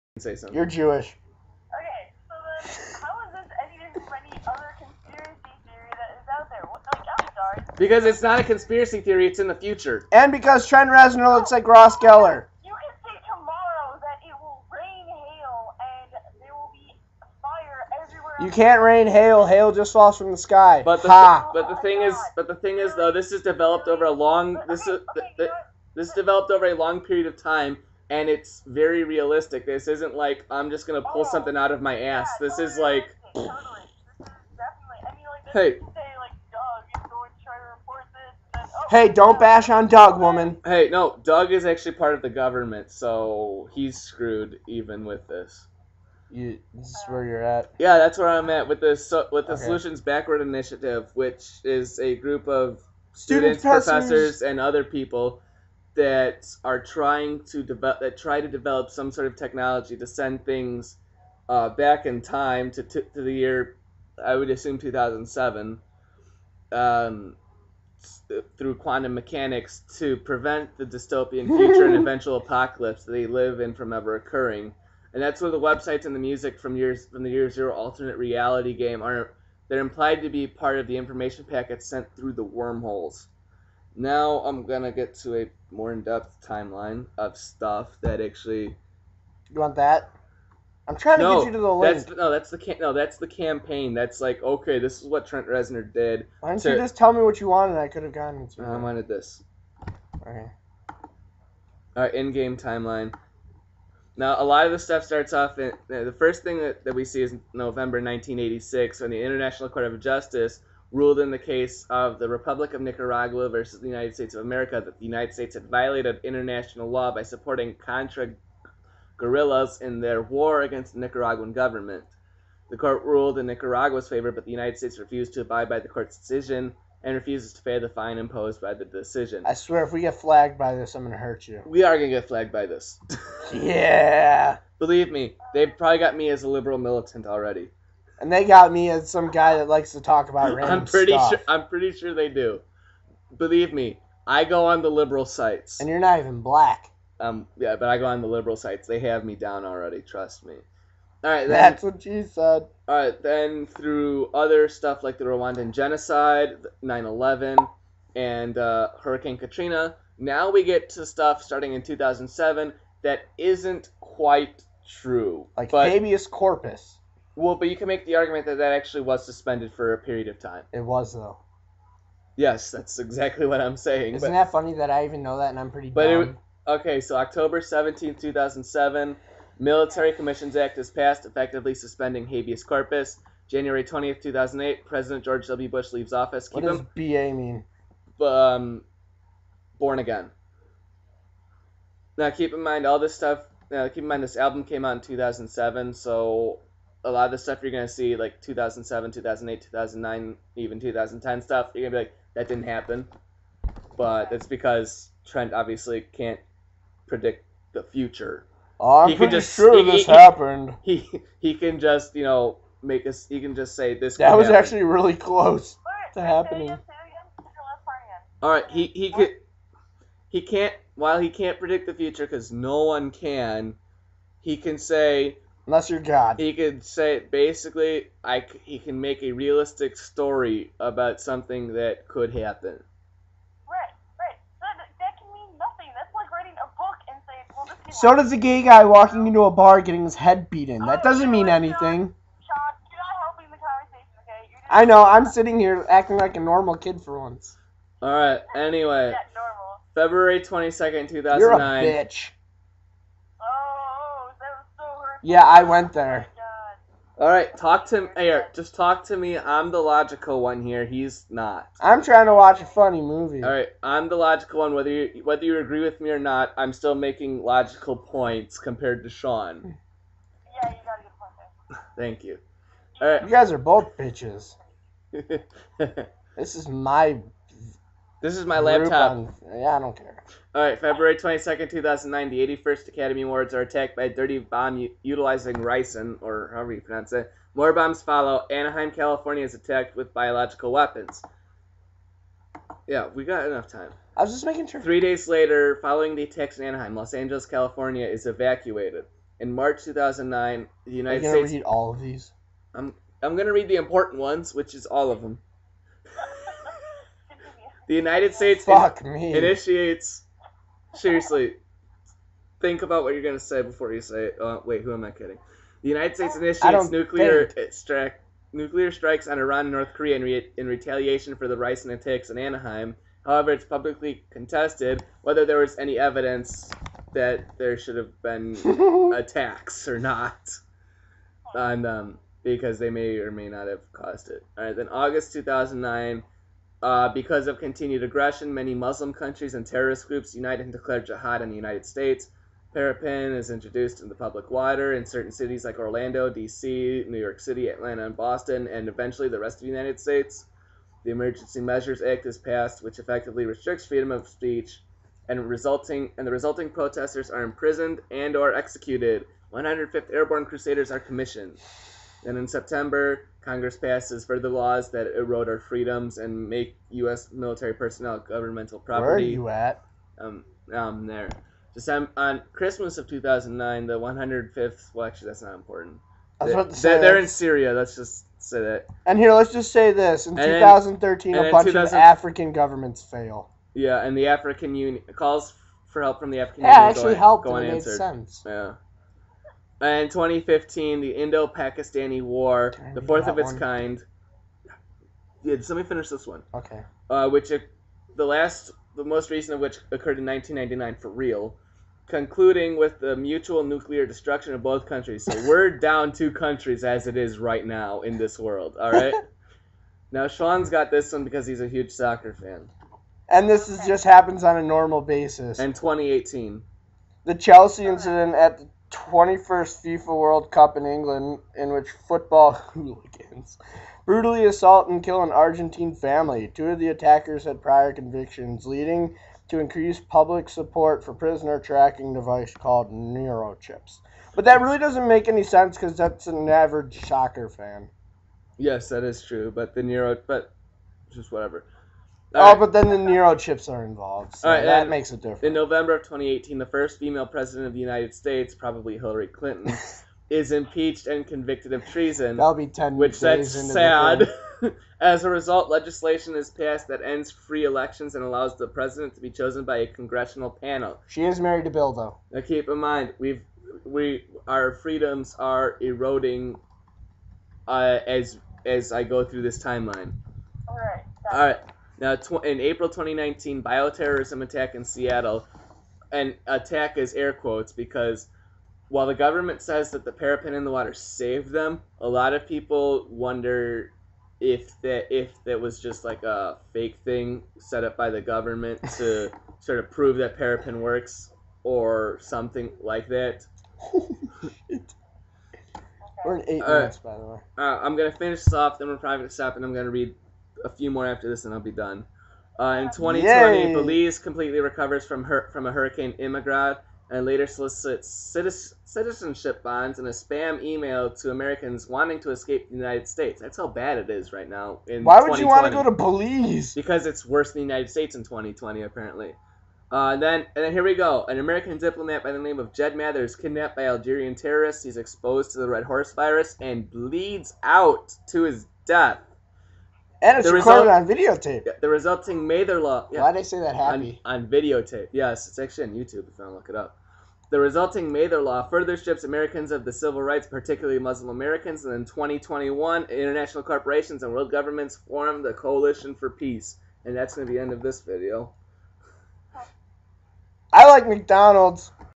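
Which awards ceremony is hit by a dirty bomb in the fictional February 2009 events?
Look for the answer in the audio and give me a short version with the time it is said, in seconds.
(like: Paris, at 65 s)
81st Academy Awards, at 282 s.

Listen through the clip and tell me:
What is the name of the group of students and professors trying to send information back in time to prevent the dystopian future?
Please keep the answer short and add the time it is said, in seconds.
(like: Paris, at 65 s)
Solutions Backward Initiative, at 49 s.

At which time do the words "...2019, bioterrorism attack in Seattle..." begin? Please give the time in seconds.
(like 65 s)
472 s.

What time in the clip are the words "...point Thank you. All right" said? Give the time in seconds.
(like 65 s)
271 s.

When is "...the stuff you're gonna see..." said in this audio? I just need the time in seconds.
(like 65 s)
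197 s.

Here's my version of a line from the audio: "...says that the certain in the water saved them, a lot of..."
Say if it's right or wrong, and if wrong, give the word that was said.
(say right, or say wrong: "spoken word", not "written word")
wrong: "parepin", not "certain".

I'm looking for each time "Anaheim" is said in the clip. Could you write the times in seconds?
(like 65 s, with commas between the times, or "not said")
288 s, 296 s, 322 s.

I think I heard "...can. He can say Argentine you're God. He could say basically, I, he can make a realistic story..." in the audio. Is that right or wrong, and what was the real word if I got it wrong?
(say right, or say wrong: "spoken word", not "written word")
wrong: "Unless", not "Argentine".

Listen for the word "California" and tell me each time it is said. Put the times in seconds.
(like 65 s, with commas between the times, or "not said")
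288 s, 297 s.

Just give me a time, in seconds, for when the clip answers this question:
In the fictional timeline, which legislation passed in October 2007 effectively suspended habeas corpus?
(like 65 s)
179 s.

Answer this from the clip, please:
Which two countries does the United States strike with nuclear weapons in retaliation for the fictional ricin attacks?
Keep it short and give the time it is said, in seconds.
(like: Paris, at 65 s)
Iran and North Korea, at 319 s.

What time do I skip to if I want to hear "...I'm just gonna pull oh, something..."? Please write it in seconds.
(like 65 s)
30 s.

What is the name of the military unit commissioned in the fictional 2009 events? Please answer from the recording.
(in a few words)
105th Airborne Crusaders.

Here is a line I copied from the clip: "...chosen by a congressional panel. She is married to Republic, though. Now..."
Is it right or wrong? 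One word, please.
wrong.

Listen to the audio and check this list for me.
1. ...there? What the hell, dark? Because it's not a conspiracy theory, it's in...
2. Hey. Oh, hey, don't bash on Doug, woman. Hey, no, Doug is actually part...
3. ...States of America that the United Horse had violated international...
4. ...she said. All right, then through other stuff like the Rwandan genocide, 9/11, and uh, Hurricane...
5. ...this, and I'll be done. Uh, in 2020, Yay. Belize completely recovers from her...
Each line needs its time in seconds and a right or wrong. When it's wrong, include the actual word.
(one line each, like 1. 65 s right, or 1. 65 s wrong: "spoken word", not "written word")
1. 6 s right
2. 35 s right
3. 114 s wrong: "States", not "Horse"
4. 152 s right
5. 501 s right.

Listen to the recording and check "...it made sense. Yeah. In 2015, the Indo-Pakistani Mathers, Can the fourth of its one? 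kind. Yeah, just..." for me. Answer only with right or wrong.
wrong.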